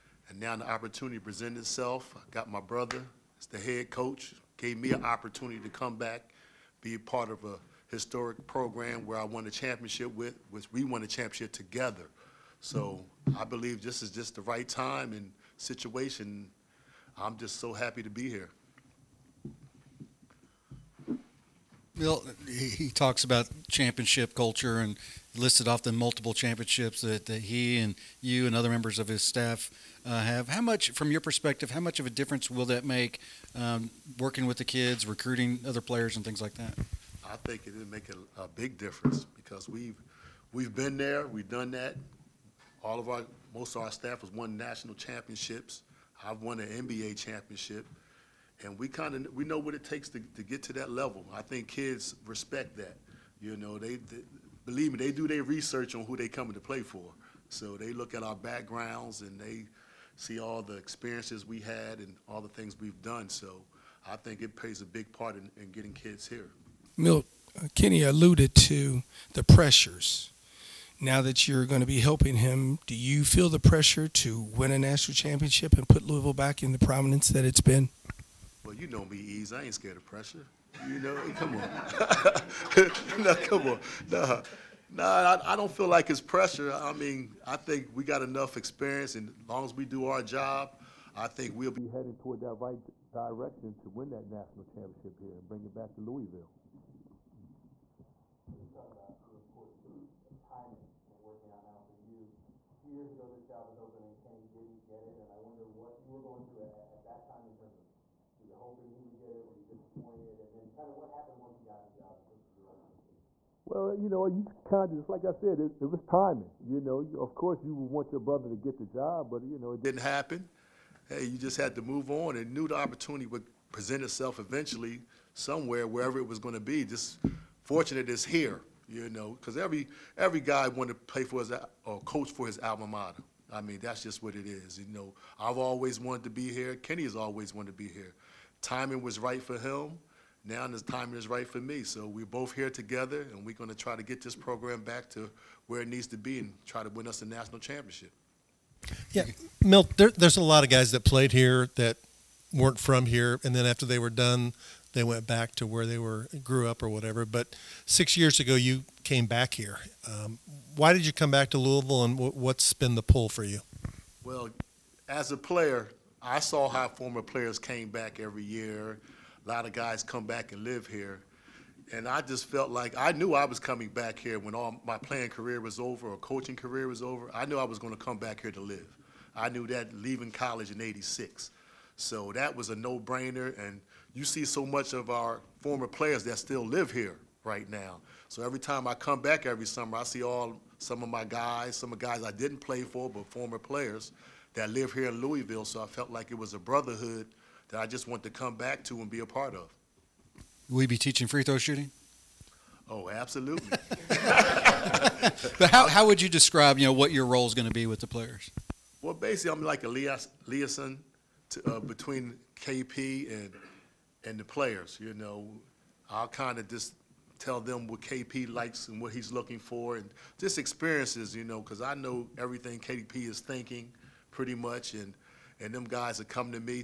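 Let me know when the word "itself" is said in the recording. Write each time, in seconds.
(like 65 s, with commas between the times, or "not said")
1 s, 124 s.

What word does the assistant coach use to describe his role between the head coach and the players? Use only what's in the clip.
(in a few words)
liaison.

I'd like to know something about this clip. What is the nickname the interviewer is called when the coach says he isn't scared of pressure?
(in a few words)
Eaves.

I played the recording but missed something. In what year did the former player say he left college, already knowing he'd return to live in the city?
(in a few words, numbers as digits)
1986.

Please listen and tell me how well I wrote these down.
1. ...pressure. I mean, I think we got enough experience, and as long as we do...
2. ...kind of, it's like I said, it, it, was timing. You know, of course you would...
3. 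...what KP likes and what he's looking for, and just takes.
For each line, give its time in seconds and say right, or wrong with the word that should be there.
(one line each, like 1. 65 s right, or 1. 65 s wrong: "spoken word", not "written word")
1. 86 s right
2. 114 s right
3. 217 s wrong: "experiences", not "takes".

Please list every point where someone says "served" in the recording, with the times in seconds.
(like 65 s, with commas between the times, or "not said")
not said.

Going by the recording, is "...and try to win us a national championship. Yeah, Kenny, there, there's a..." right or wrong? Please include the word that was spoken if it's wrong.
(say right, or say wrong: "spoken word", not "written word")
wrong: "Milt", not "Kenny".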